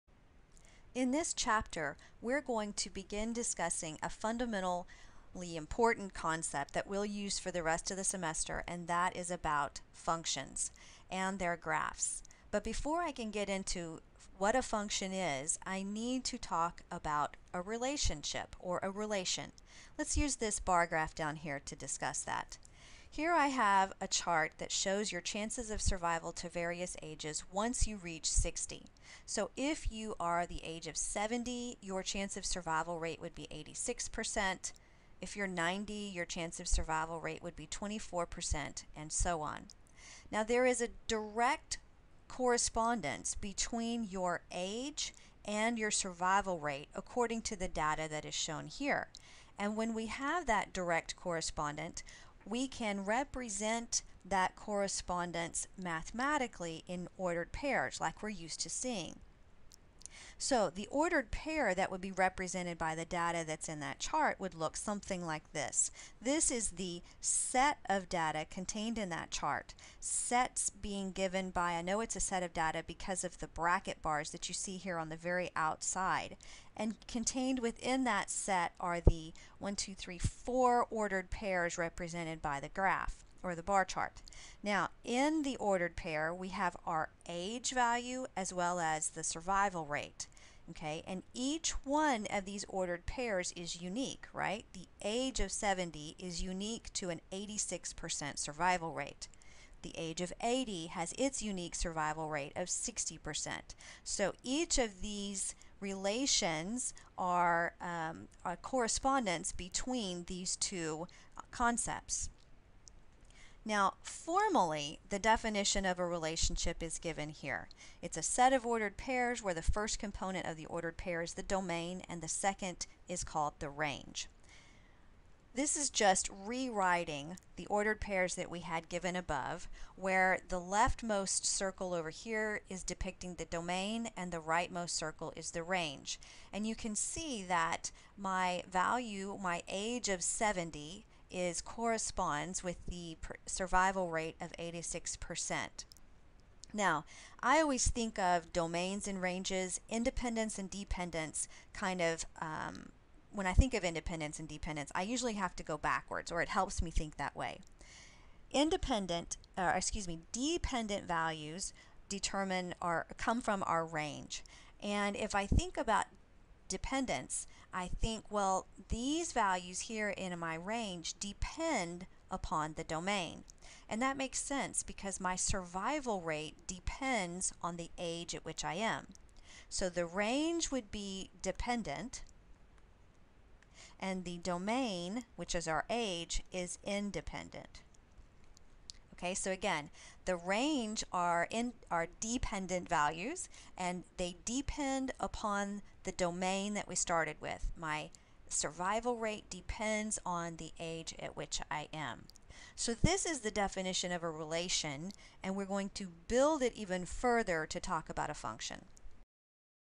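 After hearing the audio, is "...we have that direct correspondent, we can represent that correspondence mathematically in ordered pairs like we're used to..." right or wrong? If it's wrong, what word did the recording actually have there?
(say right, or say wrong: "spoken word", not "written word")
right.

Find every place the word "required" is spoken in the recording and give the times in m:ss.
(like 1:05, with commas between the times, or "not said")
not said.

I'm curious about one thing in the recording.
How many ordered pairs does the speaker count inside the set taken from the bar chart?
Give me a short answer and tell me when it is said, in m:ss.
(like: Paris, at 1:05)
4, at 1:20.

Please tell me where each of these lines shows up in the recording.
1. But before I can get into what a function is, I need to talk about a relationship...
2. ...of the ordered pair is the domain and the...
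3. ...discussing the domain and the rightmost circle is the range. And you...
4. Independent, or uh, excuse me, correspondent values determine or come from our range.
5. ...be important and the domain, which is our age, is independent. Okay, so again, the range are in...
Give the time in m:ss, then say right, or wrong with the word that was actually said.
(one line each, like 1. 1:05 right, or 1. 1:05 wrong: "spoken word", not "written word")
1. 0:12 right
2. 2:00 right
3. 2:12 wrong: "depicting", not "discussing"
4. 2:38 wrong: "dependent", not "correspondent"
5. 3:00 wrong: "dependent", not "important".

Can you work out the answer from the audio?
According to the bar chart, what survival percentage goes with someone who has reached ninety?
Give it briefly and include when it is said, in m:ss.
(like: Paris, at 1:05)
24%, at 0:37.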